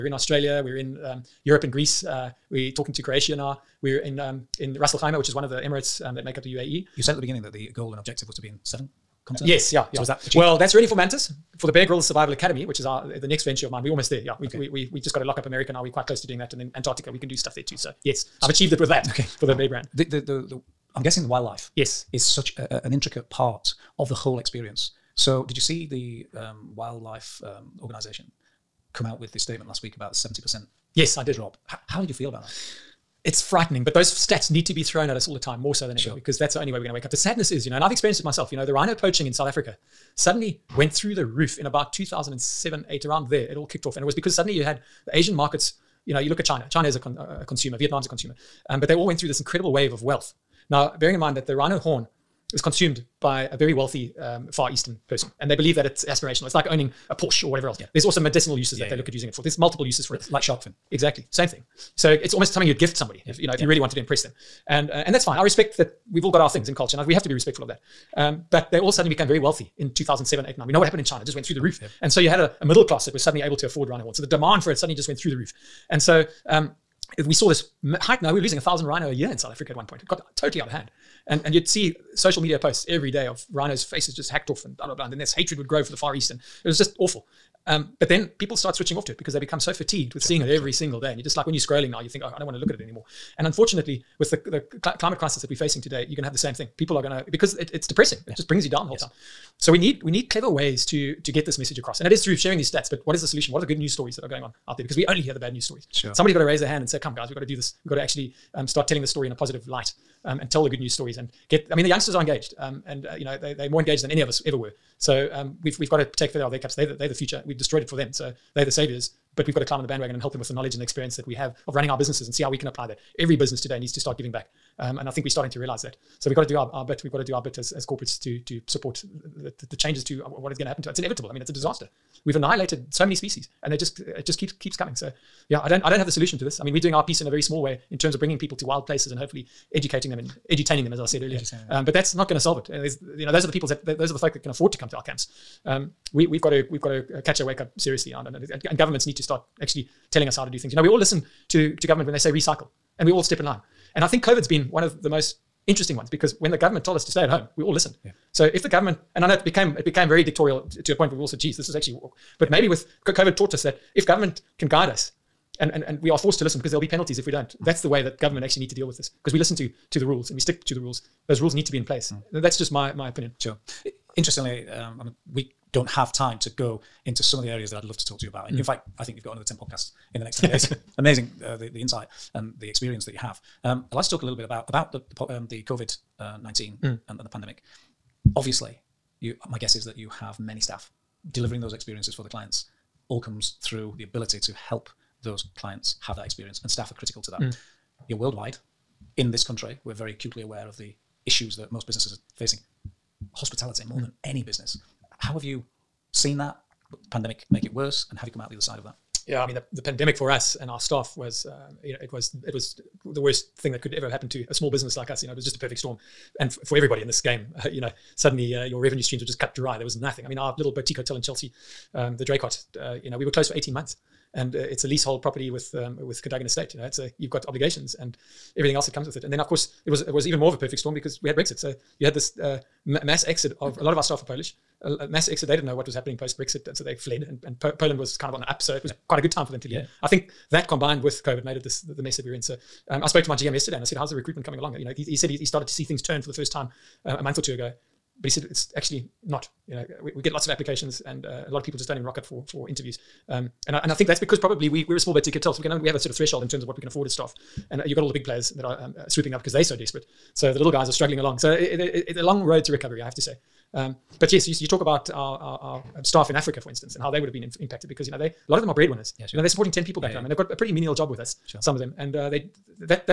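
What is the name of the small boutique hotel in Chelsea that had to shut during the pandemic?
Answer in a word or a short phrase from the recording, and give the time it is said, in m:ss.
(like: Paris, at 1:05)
the Draycott, at 3:42.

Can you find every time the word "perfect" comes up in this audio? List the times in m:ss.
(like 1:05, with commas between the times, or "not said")
3:35, 3:50.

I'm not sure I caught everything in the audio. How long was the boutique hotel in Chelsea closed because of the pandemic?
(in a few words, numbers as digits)
18 months.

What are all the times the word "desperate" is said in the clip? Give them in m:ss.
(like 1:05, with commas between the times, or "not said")
4:19.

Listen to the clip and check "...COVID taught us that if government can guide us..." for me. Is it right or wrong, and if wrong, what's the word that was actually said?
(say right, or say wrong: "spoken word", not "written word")
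right.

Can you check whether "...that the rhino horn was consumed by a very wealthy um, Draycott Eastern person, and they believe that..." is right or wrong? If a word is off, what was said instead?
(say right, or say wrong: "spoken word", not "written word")
wrong: "Far", not "Draycott".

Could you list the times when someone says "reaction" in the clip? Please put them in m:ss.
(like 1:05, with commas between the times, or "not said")
not said.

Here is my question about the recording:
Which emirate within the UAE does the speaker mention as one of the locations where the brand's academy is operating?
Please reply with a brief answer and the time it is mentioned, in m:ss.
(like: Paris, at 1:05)
Ras Al Khaimah, at 0:04.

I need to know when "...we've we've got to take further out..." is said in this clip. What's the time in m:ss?
1:55.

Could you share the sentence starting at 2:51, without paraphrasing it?
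Those rules need to be in place.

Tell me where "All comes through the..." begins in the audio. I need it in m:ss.
3:13.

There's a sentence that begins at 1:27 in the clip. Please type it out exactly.
Um, but then people start switching off to it because they become so fatigued with sure.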